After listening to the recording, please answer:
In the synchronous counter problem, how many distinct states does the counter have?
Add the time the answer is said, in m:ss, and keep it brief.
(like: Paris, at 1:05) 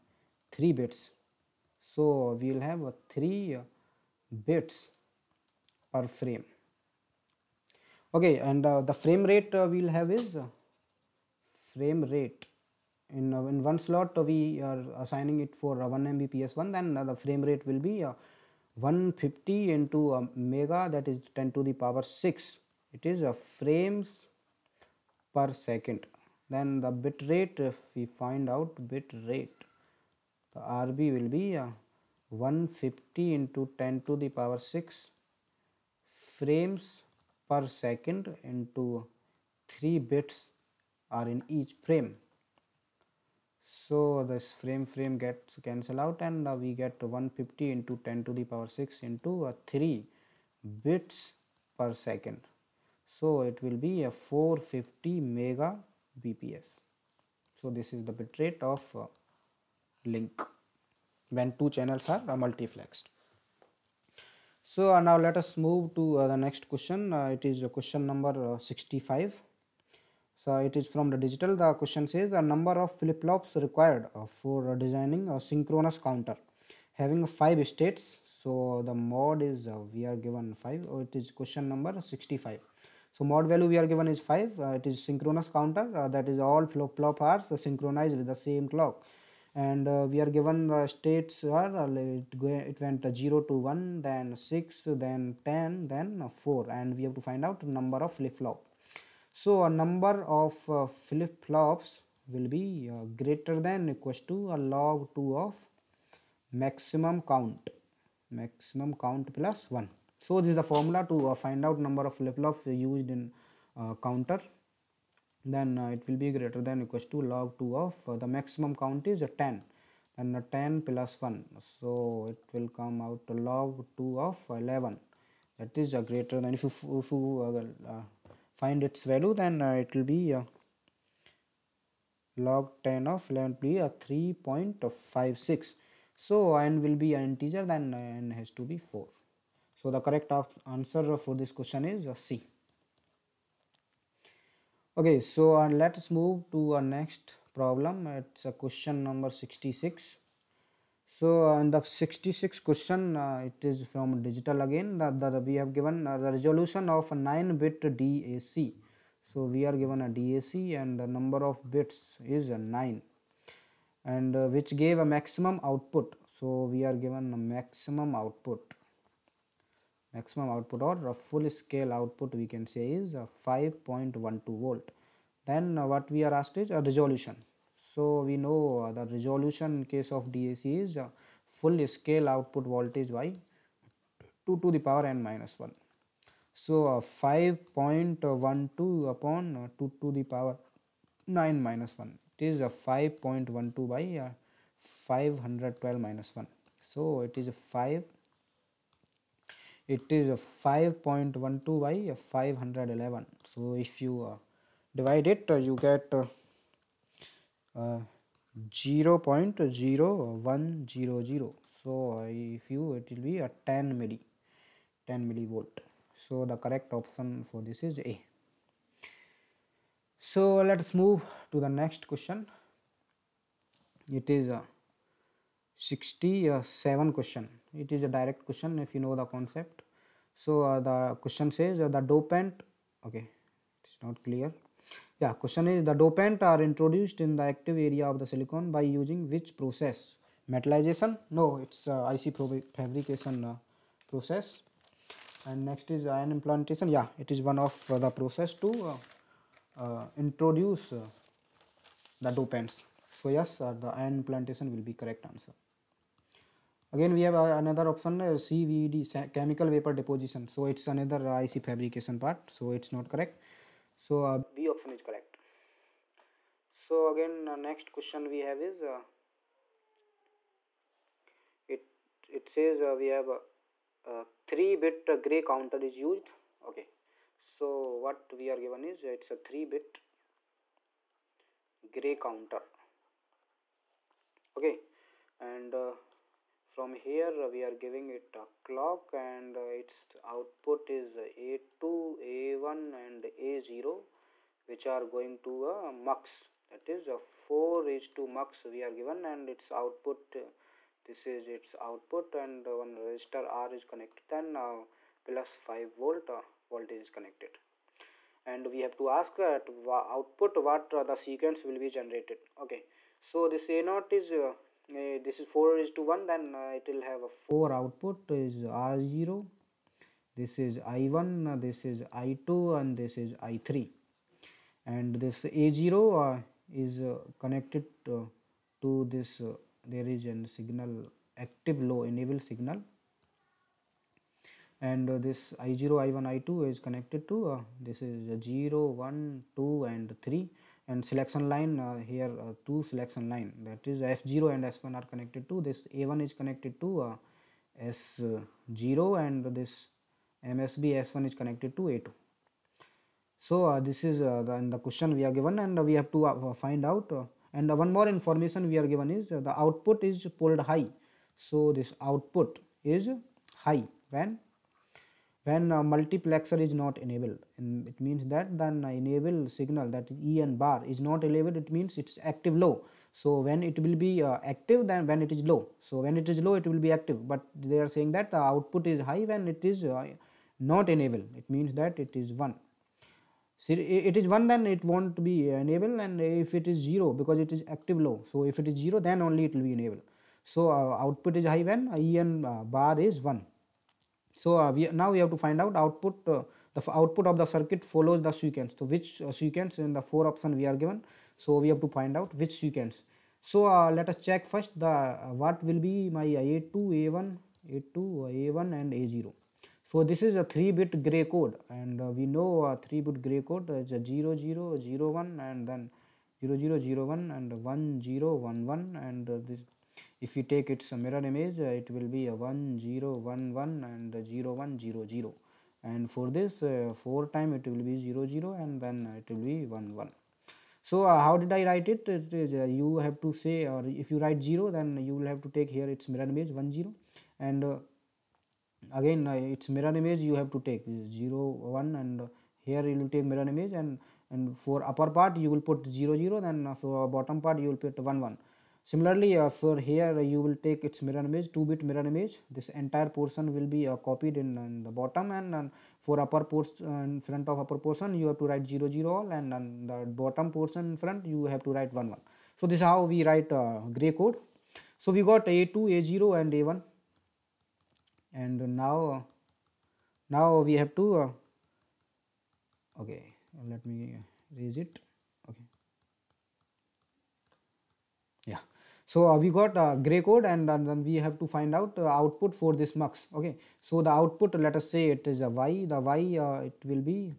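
5, at 1:17.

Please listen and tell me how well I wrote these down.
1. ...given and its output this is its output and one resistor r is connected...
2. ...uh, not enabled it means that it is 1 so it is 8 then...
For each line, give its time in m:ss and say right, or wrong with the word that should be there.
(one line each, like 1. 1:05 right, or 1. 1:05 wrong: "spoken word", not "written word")
1. 4:58 right
2. 6:19 wrong: "1", not "8".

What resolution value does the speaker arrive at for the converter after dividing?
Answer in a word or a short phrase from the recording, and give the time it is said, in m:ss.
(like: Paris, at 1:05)
10 millivolts, at 3:35.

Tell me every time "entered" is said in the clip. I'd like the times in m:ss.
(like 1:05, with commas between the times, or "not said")
not said.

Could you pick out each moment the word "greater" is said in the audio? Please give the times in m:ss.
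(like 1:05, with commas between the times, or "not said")
1:43, 1:56, 2:06.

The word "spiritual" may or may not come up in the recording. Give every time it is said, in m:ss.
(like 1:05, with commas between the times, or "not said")
not said.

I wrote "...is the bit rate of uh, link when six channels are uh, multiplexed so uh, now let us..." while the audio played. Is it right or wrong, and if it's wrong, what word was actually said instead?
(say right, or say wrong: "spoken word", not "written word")
wrong: "two", not "six".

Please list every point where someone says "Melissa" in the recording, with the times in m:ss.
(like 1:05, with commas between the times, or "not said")
not said.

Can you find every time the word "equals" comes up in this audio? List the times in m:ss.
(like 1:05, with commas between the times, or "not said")
1:43, 1:56.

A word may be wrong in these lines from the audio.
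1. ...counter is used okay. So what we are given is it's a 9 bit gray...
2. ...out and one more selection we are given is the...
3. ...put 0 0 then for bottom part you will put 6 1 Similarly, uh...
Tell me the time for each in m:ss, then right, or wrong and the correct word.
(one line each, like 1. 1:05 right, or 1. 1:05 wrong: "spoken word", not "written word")
1. 4:35 wrong: "3", not "9"
2. 5:56 wrong: "information", not "selection"
3. 7:25 wrong: "1", not "6".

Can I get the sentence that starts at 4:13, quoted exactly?
So yes, the ion implantation will be correct answer.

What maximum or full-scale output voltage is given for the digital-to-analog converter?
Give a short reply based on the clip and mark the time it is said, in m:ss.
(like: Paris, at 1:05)
5.12 volts, at 2:53.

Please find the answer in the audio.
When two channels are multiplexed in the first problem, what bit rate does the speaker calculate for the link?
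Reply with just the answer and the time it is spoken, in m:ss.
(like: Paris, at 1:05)
450 Mbps, at 0:54.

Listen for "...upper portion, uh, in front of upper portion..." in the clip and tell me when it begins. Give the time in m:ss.
7:36.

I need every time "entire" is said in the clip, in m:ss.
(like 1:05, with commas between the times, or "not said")
7:32.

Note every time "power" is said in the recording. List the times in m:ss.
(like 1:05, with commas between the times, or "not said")
0:21, 0:34, 0:48, 3:04, 3:10.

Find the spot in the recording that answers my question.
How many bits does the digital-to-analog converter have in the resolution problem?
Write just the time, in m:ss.
2:37.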